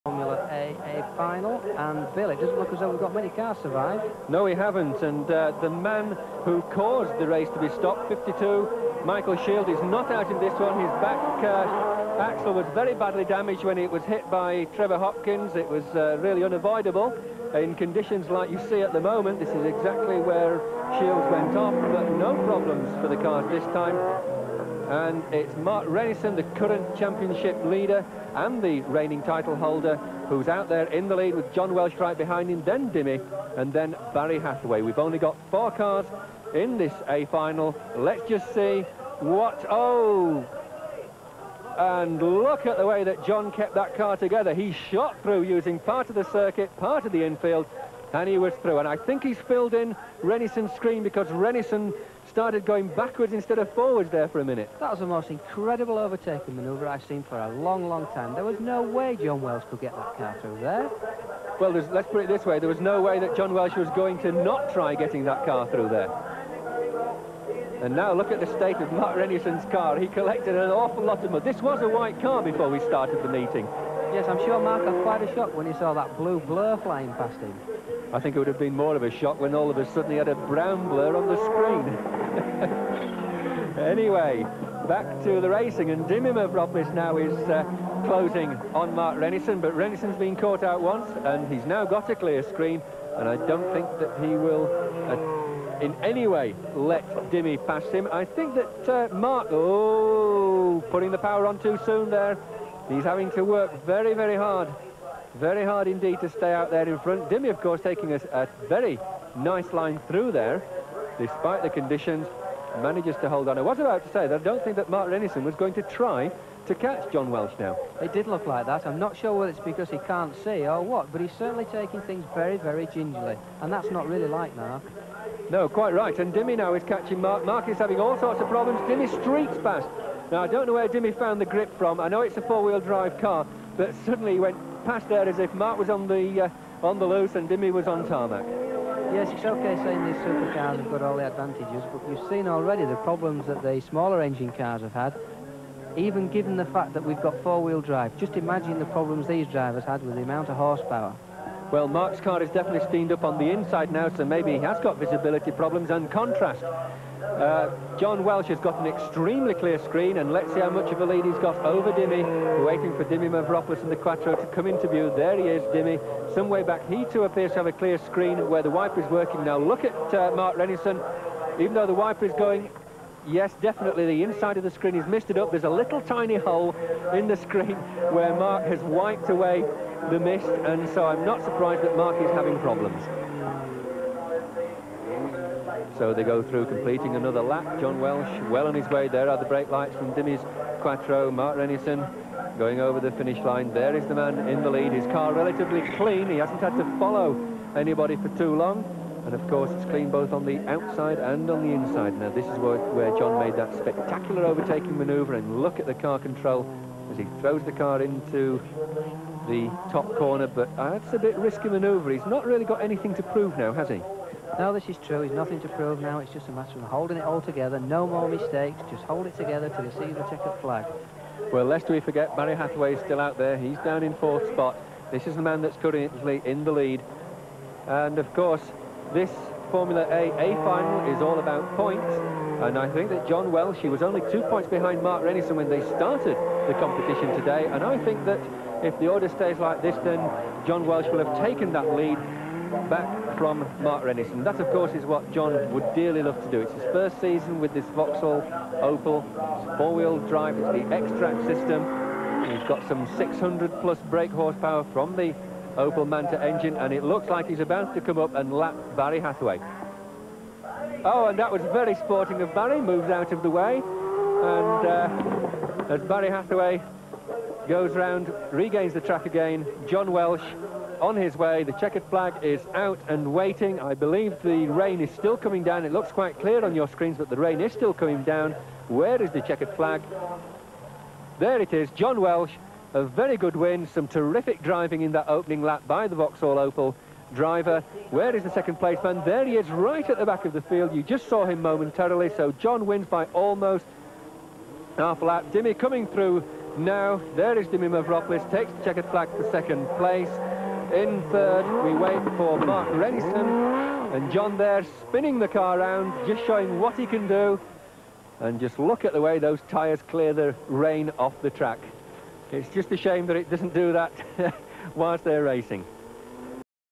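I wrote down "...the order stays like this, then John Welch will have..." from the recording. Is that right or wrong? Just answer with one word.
right.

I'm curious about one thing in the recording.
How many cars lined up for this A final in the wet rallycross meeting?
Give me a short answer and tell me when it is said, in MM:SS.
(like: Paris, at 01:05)
4, at 00:35.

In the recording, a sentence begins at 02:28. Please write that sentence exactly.
Just imagine the problems these drivers had with the amount of horsepower.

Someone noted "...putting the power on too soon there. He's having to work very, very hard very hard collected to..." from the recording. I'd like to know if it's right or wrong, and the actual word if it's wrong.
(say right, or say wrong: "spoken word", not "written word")
wrong: "indeed", not "collected".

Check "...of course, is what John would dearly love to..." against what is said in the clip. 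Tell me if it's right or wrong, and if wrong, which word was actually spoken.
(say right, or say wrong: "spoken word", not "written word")
right.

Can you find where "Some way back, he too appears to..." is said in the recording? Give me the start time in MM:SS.
02:46.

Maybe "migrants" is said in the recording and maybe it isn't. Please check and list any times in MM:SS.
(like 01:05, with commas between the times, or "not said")
not said.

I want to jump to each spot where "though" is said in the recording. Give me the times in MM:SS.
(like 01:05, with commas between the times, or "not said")
00:02, 02:51.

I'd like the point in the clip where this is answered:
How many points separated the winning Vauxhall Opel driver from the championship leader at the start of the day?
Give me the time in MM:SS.
03:54.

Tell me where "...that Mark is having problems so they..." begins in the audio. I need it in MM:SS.
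03:01.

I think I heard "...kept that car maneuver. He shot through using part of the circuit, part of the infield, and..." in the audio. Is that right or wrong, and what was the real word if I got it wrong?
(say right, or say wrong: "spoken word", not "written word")
wrong: "together", not "maneuver".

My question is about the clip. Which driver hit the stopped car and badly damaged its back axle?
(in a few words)
Trevor Hopkins.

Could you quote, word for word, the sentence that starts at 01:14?
Yes, I'm sure Mark had quite a shock when he saw that blue blur flying past him.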